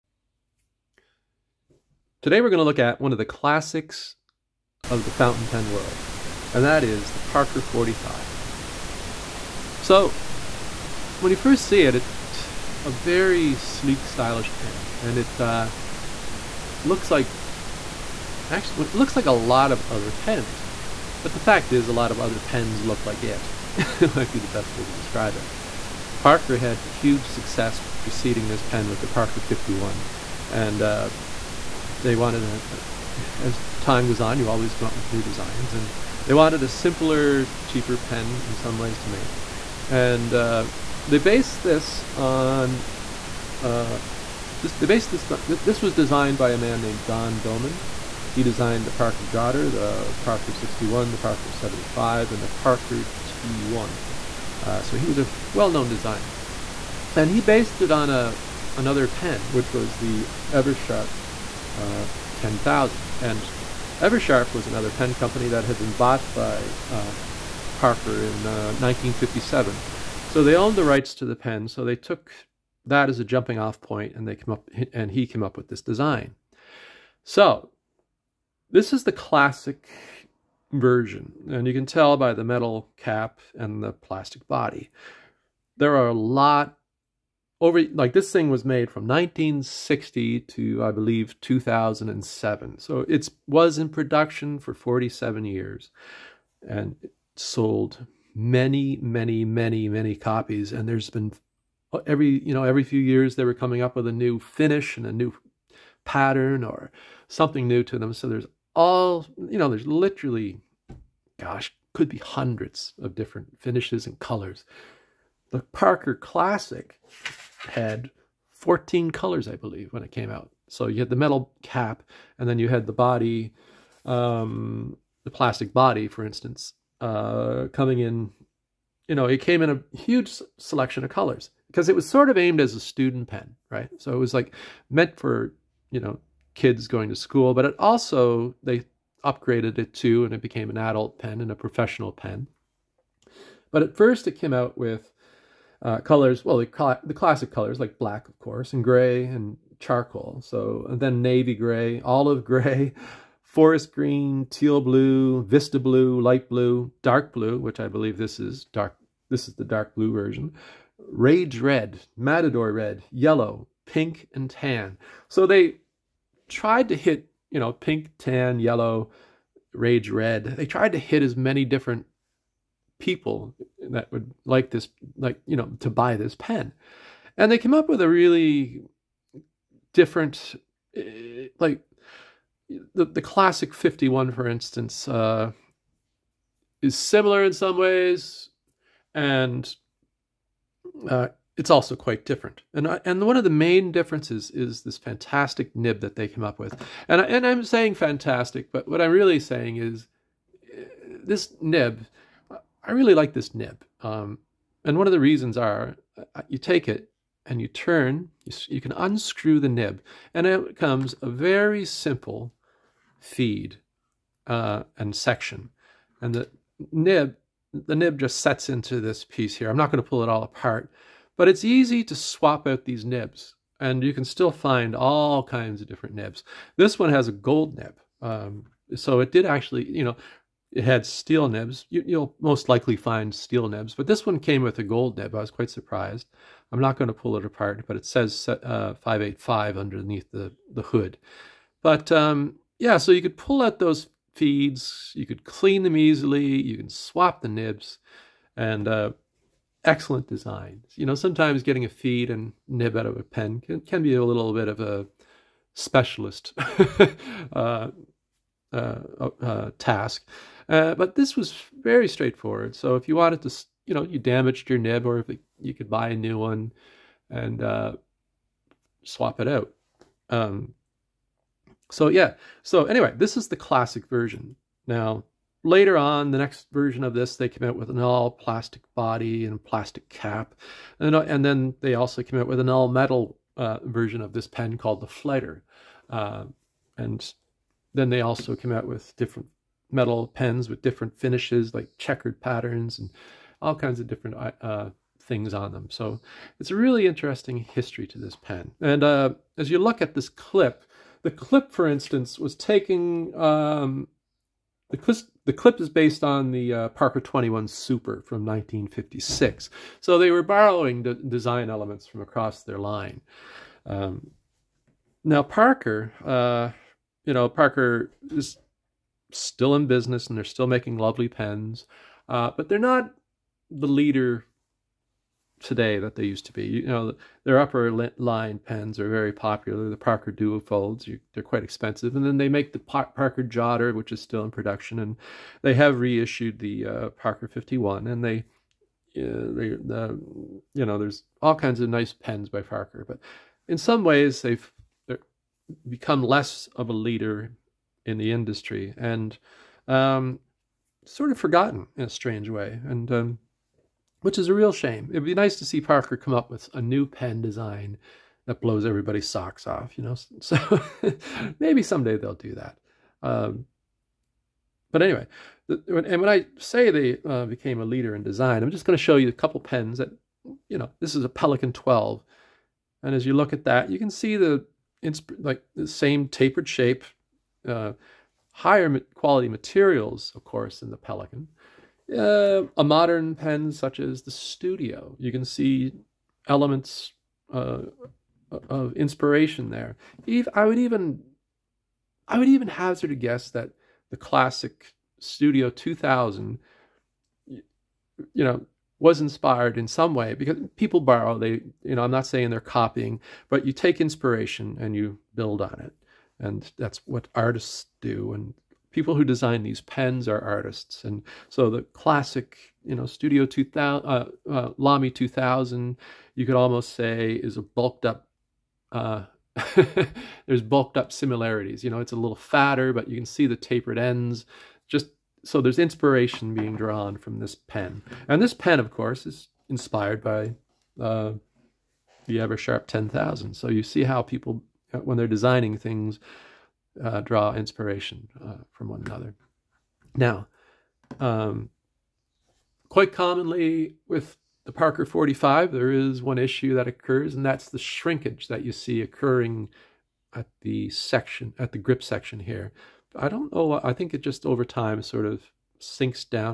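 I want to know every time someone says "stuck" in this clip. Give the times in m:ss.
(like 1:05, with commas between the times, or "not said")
not said.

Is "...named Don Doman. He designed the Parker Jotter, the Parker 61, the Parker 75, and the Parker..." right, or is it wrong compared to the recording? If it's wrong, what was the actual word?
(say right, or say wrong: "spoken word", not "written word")
right.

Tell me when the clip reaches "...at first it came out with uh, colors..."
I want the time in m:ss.
2:23.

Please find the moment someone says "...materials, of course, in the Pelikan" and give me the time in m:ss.
6:19.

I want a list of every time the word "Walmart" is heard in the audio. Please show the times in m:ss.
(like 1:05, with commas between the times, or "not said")
not said.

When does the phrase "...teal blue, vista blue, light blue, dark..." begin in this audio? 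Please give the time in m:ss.
2:34.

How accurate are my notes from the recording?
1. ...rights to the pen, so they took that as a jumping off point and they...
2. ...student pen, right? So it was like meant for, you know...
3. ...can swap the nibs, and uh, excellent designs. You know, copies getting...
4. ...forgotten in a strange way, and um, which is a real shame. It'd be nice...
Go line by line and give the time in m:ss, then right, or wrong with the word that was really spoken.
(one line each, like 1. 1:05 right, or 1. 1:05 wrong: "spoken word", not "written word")
1. 1:10 right
2. 2:12 right
3. 4:06 wrong: "sometimes", not "copies"
4. 5:51 right.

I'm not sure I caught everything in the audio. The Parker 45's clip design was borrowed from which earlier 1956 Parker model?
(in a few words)
Parker 21 Super.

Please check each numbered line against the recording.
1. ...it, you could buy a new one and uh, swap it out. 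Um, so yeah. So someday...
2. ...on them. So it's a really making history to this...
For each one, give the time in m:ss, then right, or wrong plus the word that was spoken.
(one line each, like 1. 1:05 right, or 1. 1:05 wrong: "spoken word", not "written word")
1. 4:25 wrong: "anyway", not "someday"
2. 4:55 wrong: "interesting", not "making".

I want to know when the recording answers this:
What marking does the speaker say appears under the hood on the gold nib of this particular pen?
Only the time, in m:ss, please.
3:59.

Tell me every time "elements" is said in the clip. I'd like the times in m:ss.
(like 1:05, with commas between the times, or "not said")
5:11, 6:26.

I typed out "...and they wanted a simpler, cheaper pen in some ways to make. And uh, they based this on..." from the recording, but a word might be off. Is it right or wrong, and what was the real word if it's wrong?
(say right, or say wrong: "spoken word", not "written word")
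right.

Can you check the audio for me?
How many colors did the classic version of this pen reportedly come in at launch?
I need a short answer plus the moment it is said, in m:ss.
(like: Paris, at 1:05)
14, at 1:58.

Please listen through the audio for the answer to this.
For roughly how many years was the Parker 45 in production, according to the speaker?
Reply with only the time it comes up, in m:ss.
1:34.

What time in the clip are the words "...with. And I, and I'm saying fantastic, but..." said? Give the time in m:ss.
3:16.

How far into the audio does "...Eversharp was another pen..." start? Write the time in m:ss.
1:04.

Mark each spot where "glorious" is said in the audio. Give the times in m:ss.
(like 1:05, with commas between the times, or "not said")
not said.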